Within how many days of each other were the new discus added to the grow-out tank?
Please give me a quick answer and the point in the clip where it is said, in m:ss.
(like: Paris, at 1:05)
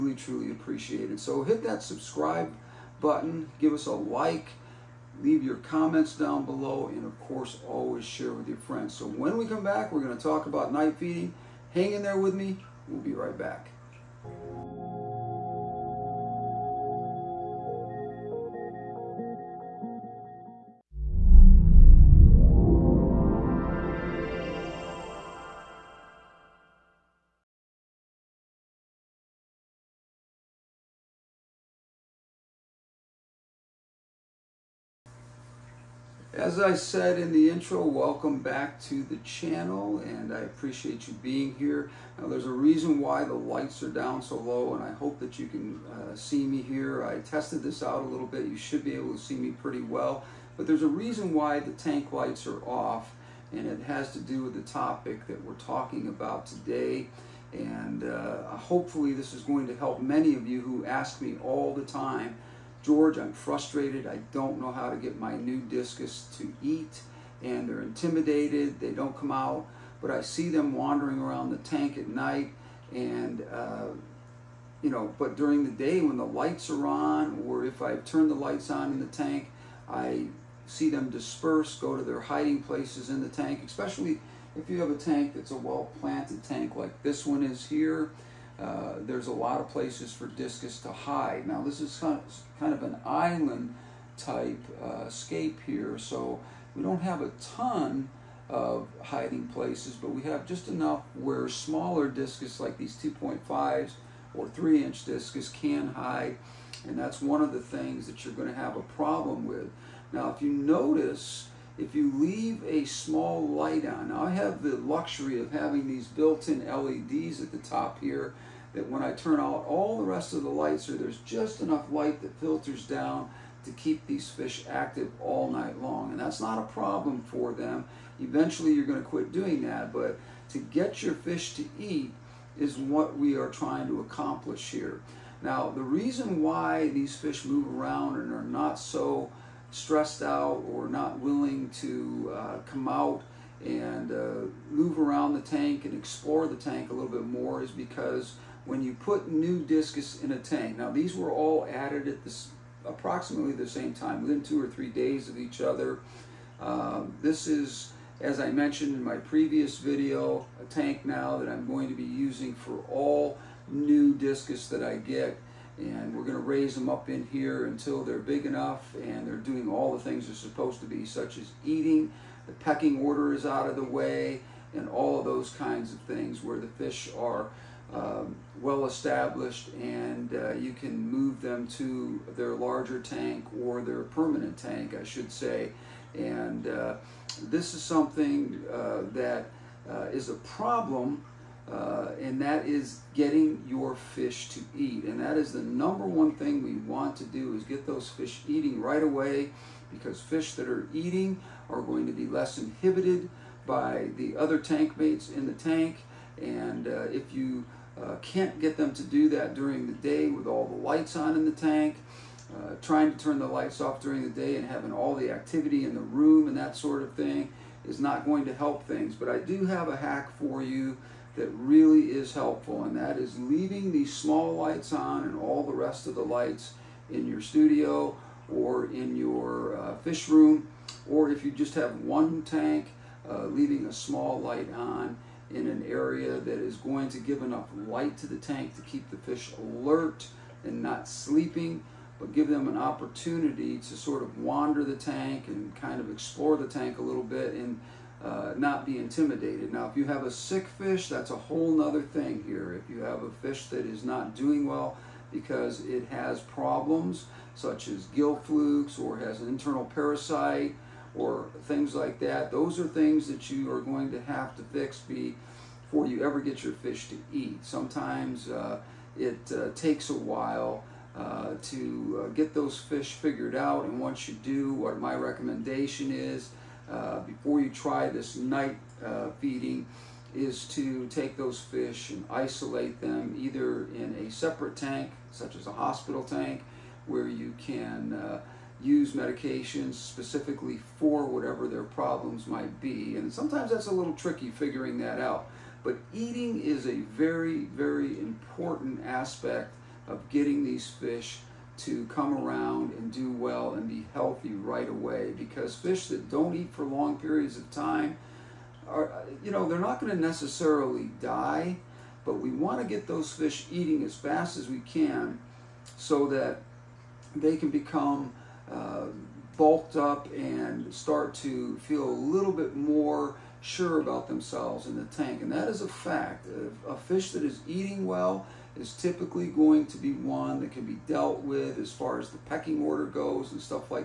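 2 or 3 days, at 2:34.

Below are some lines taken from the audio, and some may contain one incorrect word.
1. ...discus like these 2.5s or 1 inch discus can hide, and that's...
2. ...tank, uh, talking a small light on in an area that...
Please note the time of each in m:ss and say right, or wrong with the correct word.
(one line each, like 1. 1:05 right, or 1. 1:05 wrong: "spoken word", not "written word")
1. 1:42 wrong: "3", not "1"
2. 3:52 wrong: "leaving", not "talking".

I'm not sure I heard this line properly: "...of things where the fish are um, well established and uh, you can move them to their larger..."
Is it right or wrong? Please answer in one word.
right.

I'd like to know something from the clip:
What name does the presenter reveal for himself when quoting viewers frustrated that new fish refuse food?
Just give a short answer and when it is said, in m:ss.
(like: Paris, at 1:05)
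George, at 1:02.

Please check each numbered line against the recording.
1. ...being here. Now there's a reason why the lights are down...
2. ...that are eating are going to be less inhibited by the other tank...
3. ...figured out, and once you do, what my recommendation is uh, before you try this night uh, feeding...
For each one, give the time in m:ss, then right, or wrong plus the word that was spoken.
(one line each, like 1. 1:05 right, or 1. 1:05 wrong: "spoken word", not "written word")
1. 0:41 right
2. 3:20 right
3. 4:33 right.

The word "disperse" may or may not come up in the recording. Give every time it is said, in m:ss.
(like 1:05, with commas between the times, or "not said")
1:21.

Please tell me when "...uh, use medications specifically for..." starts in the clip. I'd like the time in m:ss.
4:48.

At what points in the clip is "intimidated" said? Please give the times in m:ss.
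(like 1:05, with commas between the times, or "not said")
1:07, 4:08.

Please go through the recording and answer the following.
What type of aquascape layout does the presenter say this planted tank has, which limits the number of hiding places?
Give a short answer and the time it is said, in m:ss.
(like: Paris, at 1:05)
island, at 1:33.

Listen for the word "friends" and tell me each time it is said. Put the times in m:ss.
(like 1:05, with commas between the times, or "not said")
0:08.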